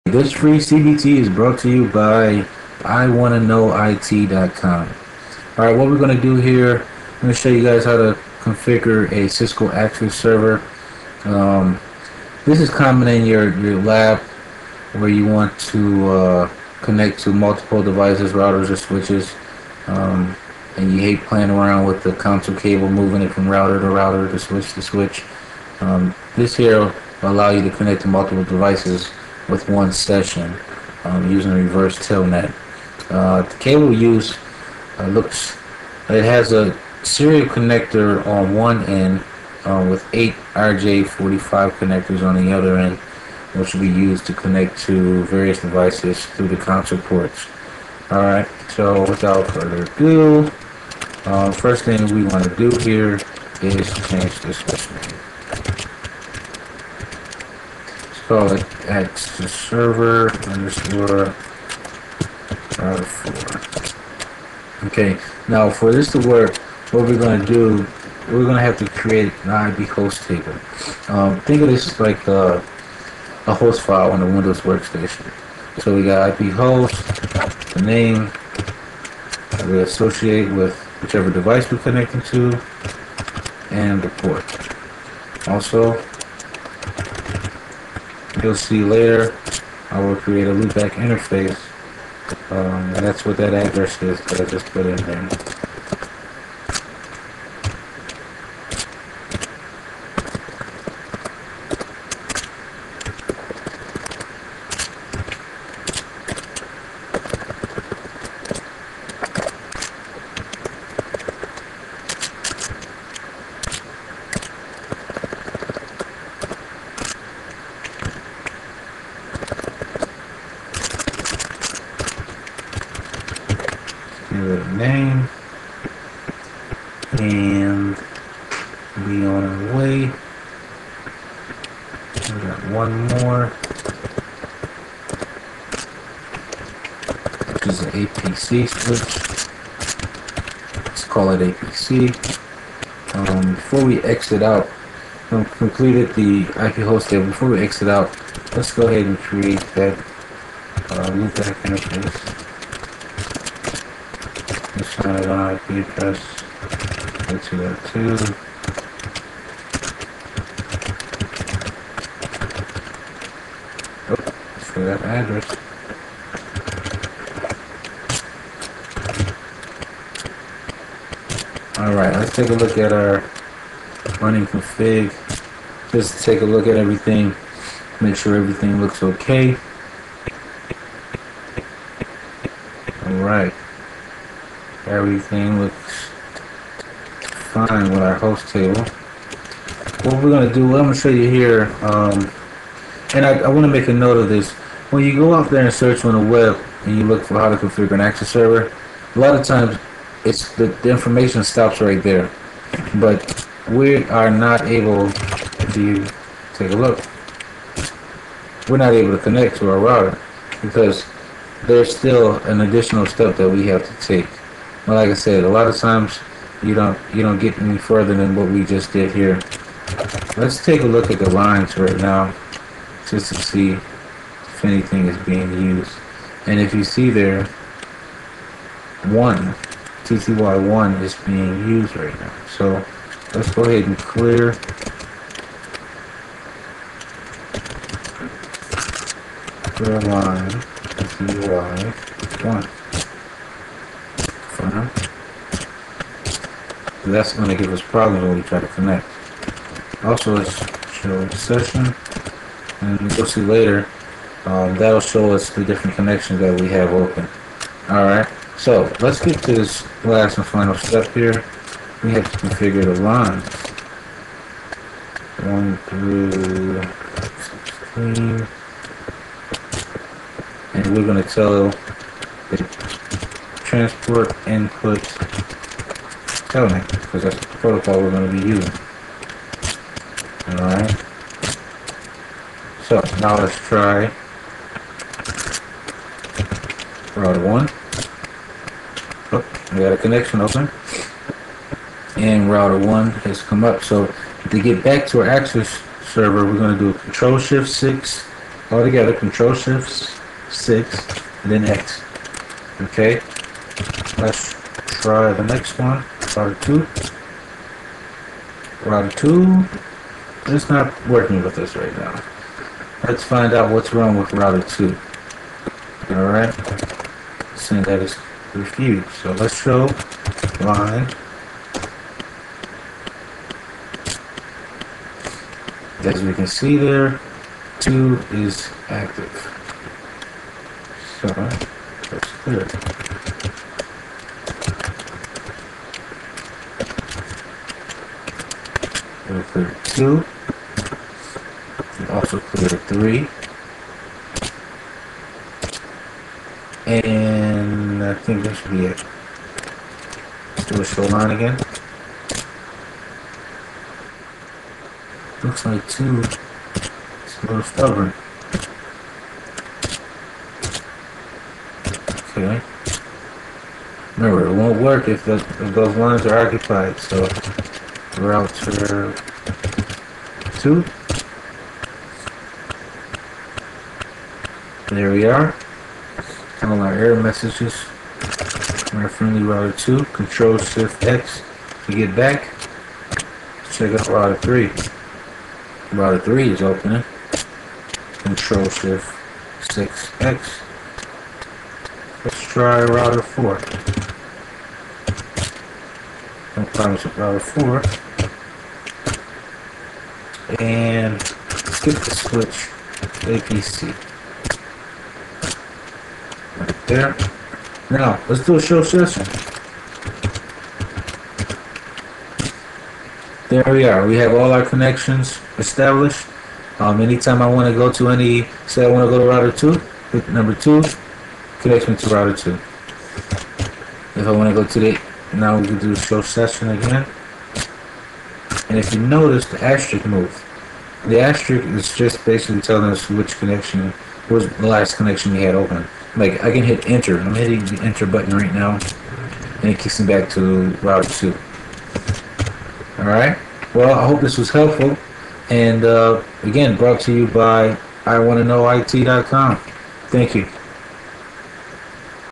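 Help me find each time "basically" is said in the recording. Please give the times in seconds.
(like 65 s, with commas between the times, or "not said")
432 s.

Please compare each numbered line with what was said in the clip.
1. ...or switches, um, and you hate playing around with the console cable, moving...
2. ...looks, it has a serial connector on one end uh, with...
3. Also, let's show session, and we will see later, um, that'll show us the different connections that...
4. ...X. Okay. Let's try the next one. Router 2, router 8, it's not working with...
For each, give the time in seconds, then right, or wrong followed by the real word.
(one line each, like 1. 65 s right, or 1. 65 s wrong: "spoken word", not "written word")
1. 18 s right
2. 35 s right
3. 250 s right
4. 301 s wrong: "2", not "8".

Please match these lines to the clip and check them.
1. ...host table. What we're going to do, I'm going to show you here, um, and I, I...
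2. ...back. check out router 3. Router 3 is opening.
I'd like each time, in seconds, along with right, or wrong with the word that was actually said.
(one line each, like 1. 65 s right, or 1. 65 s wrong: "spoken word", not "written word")
1. 188 s right
2. 382 s right.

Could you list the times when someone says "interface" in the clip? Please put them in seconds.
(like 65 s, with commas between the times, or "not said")
90 s, 151 s.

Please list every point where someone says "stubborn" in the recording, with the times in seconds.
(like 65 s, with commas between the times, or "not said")
357 s.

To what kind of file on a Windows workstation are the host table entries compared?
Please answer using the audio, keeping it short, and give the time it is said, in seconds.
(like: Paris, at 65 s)
host file, at 73 s.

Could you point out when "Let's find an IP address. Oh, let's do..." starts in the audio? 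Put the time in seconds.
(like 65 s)
154 s.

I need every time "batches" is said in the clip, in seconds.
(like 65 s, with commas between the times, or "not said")
not said.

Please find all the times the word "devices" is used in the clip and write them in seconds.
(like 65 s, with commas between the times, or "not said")
17 s, 28 s, 45 s, 81 s.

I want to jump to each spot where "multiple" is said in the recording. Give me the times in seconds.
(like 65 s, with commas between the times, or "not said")
17 s, 28 s.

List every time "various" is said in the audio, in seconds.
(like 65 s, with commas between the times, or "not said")
45 s.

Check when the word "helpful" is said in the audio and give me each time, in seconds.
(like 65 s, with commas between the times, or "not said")
444 s.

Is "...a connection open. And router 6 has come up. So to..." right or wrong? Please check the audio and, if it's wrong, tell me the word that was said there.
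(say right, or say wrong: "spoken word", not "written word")
wrong: "1", not "6".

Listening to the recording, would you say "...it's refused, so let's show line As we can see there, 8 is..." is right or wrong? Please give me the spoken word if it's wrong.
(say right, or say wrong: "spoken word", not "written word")
wrong: "2", not "8".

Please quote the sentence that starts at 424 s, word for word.
If I want to go to the, now we can do show session again.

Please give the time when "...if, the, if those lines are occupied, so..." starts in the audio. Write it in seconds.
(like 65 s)
365 s.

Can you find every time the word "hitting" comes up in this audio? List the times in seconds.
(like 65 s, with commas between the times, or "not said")
437 s.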